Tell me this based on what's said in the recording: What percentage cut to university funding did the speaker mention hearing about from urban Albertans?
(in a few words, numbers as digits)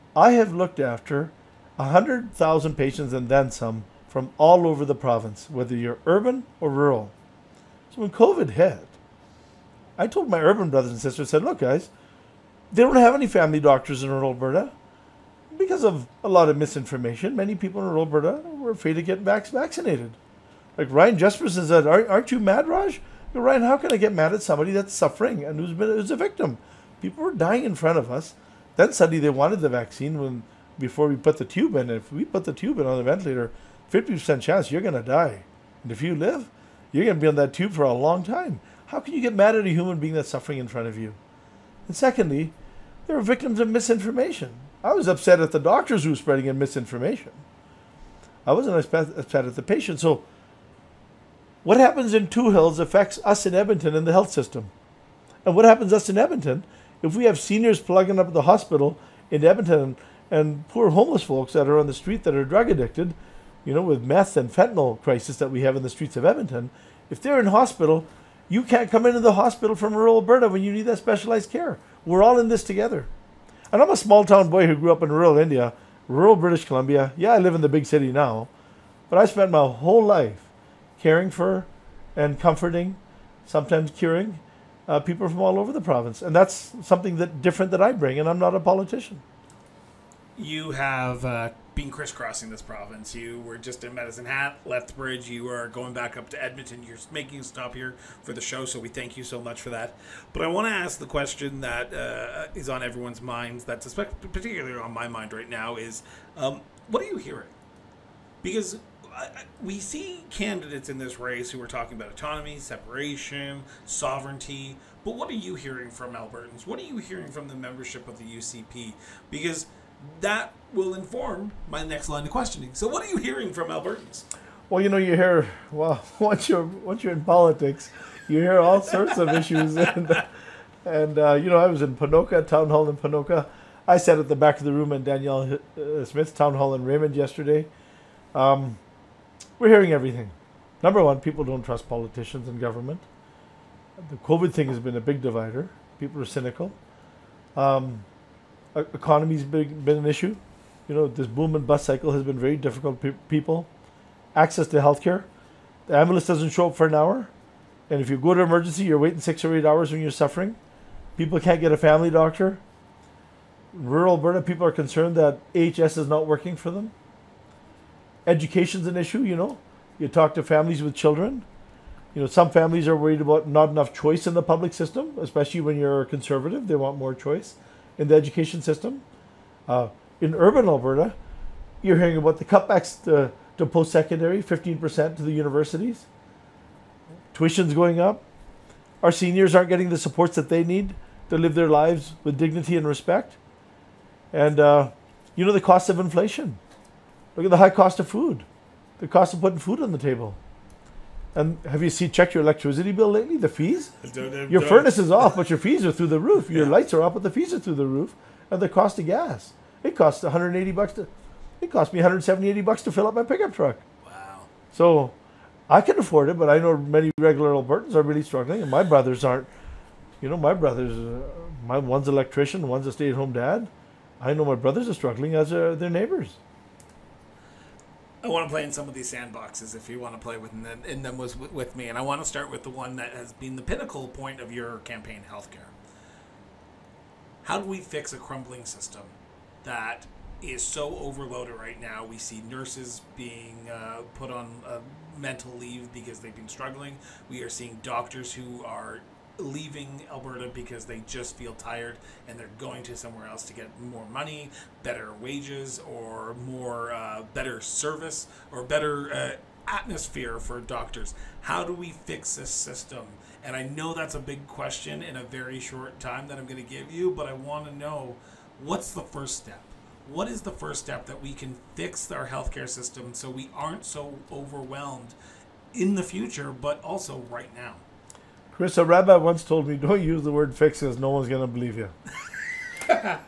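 15%.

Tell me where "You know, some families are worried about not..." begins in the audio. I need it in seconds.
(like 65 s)
172 s.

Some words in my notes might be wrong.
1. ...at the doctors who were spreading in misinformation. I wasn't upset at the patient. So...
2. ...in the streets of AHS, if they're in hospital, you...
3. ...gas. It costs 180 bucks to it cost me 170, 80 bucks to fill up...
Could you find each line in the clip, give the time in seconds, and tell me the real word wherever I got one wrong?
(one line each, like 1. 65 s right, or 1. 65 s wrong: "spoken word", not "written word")
1. 45 s right
2. 65 s wrong: "Edmonton", not "AHS"
3. 209 s right.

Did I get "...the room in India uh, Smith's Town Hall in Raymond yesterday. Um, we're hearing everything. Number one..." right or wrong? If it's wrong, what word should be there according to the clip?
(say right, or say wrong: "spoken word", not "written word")
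wrong: "Danielle", not "India".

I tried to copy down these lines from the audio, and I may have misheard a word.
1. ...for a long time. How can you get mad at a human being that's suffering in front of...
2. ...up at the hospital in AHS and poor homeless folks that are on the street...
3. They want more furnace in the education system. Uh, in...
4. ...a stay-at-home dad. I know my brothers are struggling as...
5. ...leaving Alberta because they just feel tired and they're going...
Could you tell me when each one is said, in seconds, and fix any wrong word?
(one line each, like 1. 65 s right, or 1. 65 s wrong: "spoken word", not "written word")
1. 37 s right
2. 58 s wrong: "Edmonton", not "AHS"
3. 176 s wrong: "choice", not "furnace"
4. 222 s right
5. 249 s right.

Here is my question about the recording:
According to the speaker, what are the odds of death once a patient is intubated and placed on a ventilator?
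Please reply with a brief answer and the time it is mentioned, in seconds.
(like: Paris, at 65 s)
50%, at 33 s.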